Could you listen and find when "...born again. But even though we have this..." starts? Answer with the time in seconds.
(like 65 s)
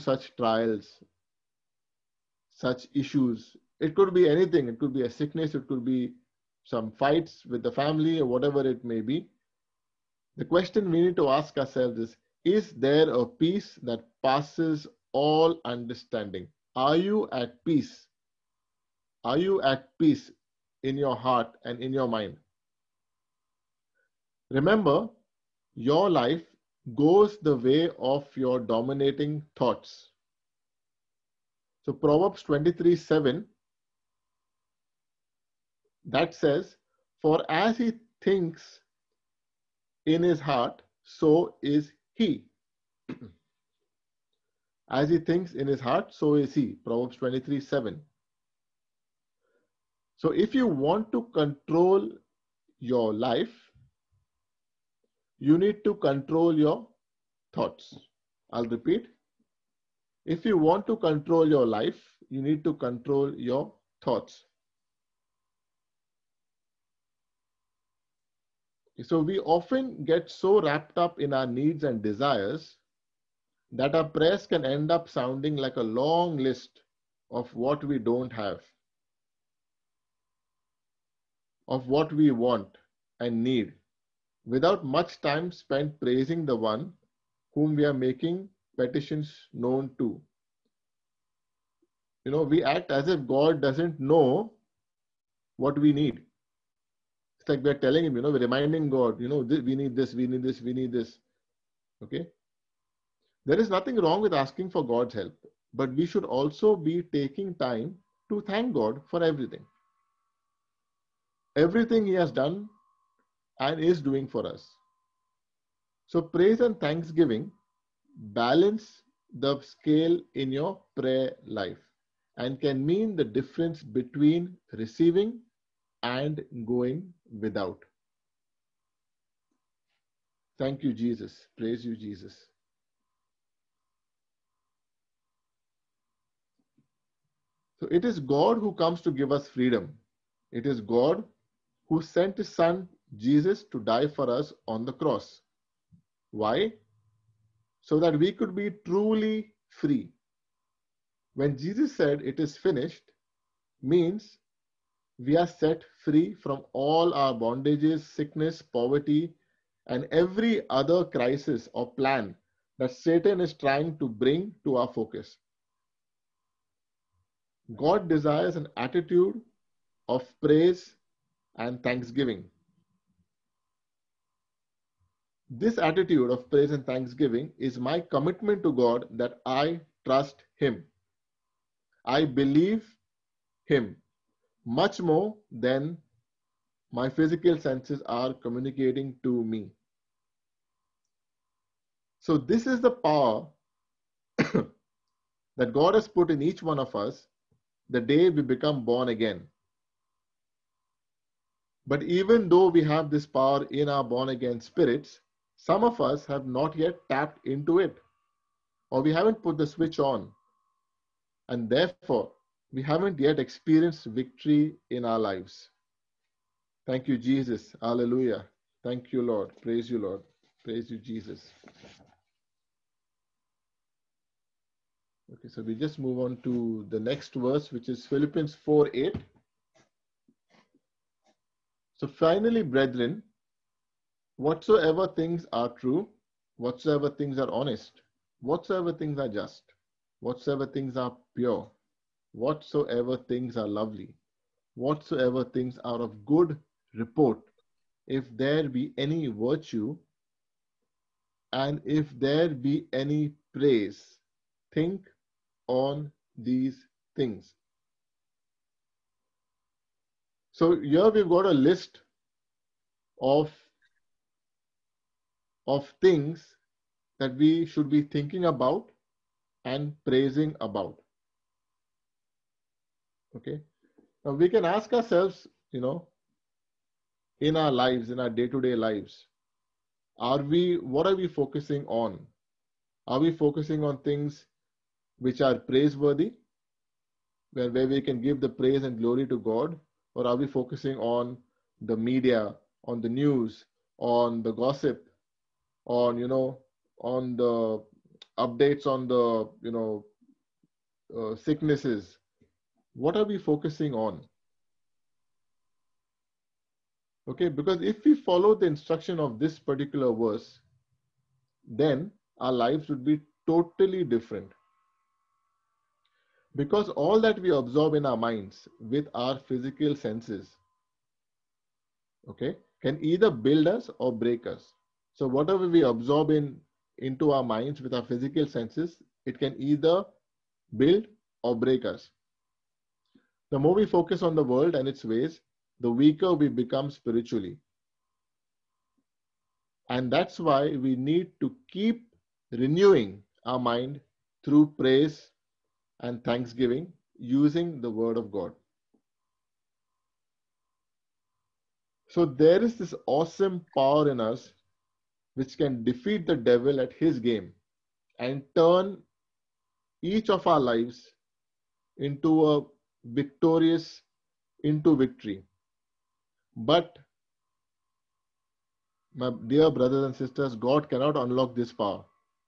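198 s.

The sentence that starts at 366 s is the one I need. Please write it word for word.
But, my dear brothers and sisters, God cannot unlock this power.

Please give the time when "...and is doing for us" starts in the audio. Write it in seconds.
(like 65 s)
113 s.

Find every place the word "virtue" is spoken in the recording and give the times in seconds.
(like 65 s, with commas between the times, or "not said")
249 s.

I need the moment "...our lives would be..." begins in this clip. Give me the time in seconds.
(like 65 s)
312 s.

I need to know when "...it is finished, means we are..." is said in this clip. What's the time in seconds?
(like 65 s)
152 s.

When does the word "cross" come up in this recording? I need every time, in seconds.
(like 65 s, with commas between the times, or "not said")
144 s.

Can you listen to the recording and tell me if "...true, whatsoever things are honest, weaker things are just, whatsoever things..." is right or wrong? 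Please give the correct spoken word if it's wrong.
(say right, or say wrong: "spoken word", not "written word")
wrong: "whatsoever", not "weaker".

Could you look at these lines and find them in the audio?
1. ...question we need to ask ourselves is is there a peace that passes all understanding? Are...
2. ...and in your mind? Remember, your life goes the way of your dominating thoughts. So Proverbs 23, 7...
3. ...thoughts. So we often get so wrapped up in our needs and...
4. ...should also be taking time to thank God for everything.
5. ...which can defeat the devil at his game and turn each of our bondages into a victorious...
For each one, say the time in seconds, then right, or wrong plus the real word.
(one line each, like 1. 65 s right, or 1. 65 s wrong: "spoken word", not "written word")
1. 10 s right
2. 21 s right
3. 64 s right
4. 106 s right
5. 355 s wrong: "lives", not "bondages".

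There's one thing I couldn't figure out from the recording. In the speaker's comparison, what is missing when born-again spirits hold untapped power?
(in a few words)
The switch on.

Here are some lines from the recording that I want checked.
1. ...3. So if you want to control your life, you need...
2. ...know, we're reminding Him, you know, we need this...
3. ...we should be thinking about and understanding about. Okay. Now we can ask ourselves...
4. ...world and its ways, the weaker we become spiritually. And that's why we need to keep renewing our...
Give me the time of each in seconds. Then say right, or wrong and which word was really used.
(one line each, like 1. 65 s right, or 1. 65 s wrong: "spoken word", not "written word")
1. 47 s wrong: "7", not "3"
2. 98 s wrong: "God", not "Him"
3. 267 s wrong: "praising", not "understanding"
4. 334 s right.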